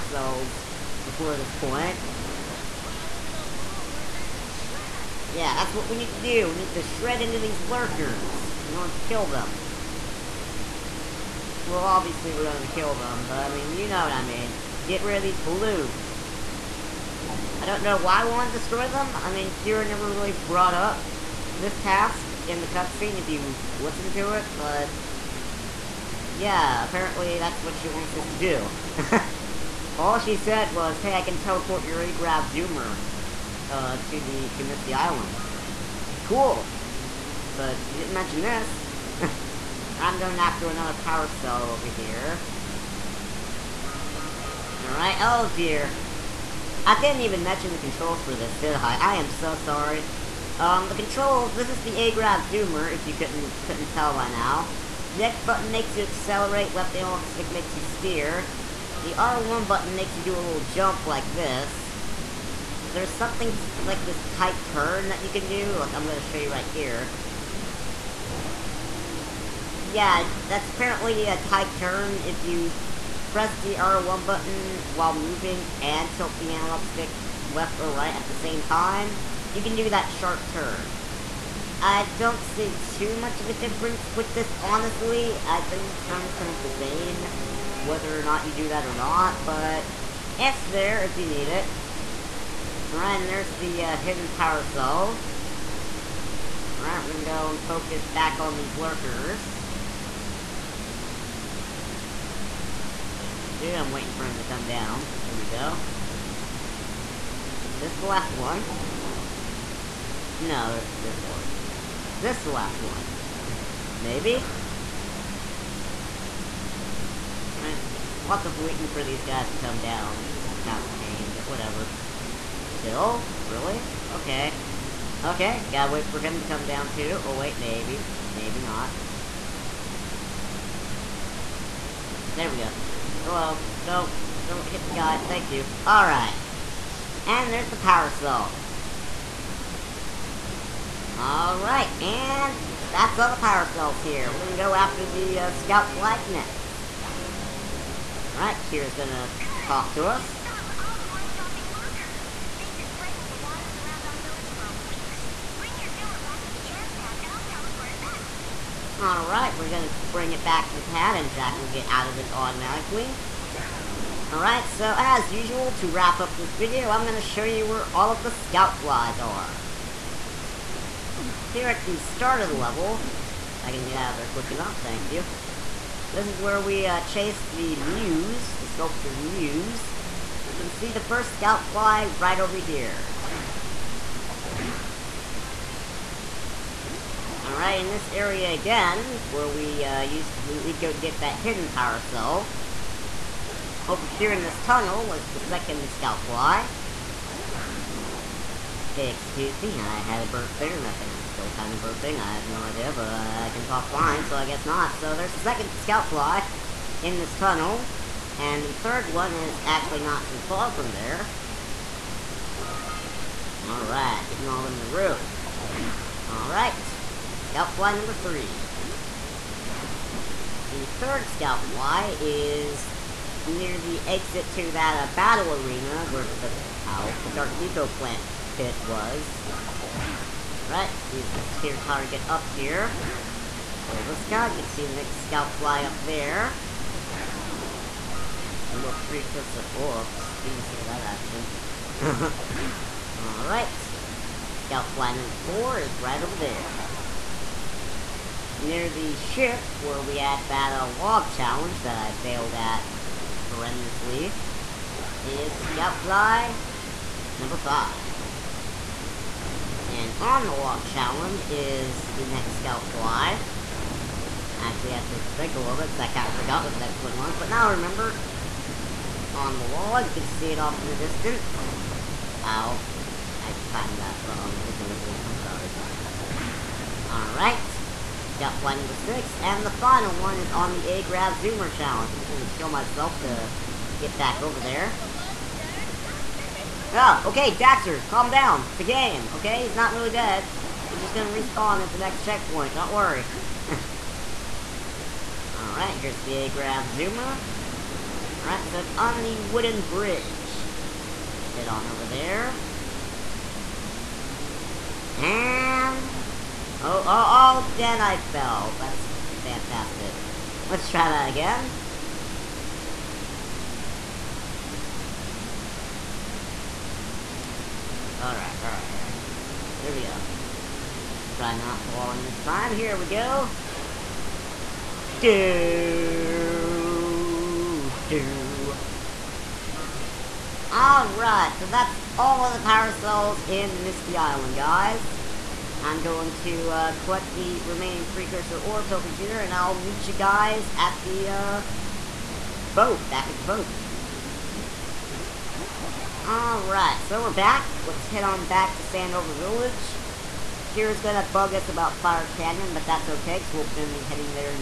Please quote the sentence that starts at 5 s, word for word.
Yeah, that's what we need to do.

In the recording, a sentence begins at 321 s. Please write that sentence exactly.
Let's try not falling this time.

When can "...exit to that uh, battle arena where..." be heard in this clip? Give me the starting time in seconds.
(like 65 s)
224 s.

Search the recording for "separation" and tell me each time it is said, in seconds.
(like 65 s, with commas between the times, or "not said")
not said.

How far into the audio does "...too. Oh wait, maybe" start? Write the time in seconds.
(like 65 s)
126 s.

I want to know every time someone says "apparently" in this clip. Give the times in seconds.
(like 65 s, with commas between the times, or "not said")
26 s, 70 s.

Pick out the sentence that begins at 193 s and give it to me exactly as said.
Over here in this tunnel was the second scout fly.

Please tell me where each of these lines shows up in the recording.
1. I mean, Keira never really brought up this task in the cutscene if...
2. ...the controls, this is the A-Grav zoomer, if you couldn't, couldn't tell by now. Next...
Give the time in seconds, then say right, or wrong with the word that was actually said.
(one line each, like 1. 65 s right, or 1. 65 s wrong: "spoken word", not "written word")
1. 19 s right
2. 50 s right.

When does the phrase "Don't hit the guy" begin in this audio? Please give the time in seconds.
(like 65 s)
134 s.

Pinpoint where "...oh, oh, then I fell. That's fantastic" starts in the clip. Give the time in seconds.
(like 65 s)
307 s.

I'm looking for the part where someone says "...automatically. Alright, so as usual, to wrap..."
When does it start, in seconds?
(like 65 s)
162 s.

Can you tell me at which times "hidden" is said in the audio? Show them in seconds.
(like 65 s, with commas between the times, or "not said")
93 s, 191 s.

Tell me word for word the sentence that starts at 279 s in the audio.
And the final one is on the A-Grav Zoomer Challenge.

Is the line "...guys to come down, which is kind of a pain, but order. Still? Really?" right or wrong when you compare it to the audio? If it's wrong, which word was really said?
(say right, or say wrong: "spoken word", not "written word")
wrong: "whatever", not "order".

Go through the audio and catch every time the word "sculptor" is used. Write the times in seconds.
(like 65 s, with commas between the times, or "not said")
178 s.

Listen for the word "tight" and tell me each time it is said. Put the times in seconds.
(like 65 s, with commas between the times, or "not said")
64 s, 71 s.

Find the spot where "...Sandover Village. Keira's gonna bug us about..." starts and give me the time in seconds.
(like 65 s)
348 s.